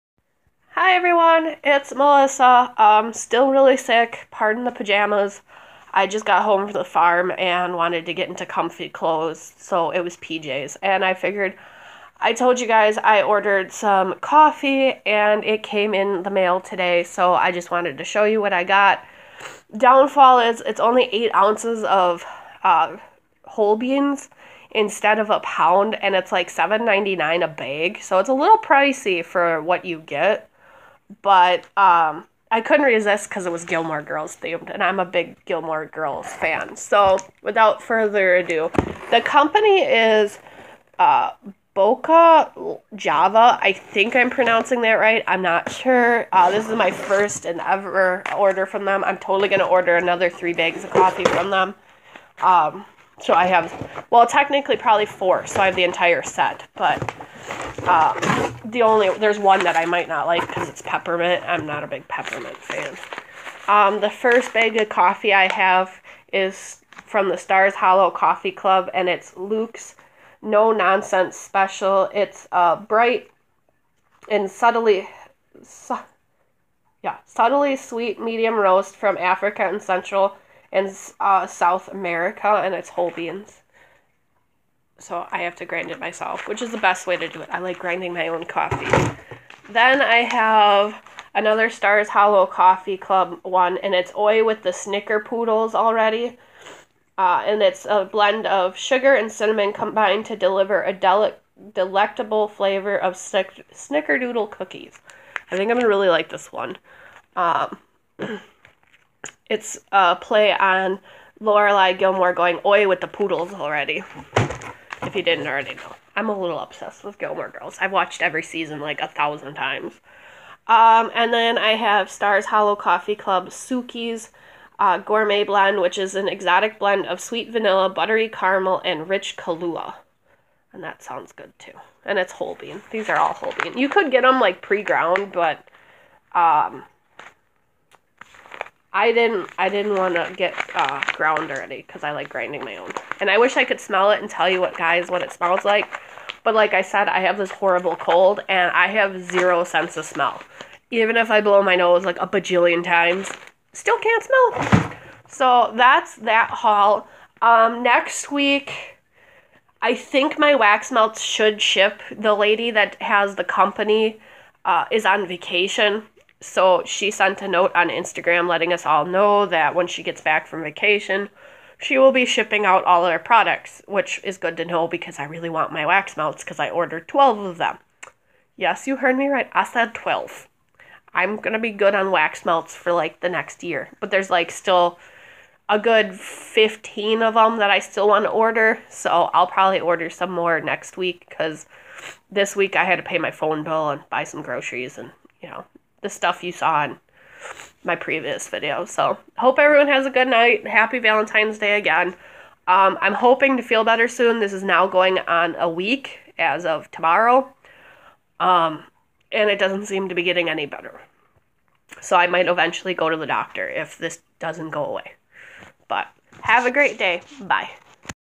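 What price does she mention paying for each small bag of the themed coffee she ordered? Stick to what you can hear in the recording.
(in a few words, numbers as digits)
$7.99.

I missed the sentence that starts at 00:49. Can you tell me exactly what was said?
I'm totally going to order another three bags of coffee from them.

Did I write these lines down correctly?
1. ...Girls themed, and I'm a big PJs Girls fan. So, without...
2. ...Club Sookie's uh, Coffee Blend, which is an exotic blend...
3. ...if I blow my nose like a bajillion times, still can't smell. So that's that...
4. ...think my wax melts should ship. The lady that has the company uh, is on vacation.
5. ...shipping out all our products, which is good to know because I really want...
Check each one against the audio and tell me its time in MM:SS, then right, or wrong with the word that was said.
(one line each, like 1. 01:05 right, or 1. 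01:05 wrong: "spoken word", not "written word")
1. 00:34 wrong: "Gilmore", not "PJs"
2. 02:03 wrong: "Gourmet", not "Coffee"
3. 02:31 right
4. 02:39 right
5. 02:52 right.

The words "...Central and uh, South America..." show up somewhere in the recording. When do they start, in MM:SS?
01:19.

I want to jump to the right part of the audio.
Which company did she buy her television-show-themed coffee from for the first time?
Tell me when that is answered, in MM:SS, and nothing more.
00:41.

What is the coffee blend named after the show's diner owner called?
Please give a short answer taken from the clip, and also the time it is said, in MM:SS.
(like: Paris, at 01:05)
Luke's No Nonsense Special, at 01:09.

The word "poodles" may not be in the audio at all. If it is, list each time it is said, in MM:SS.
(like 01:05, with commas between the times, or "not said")
01:35, 01:53.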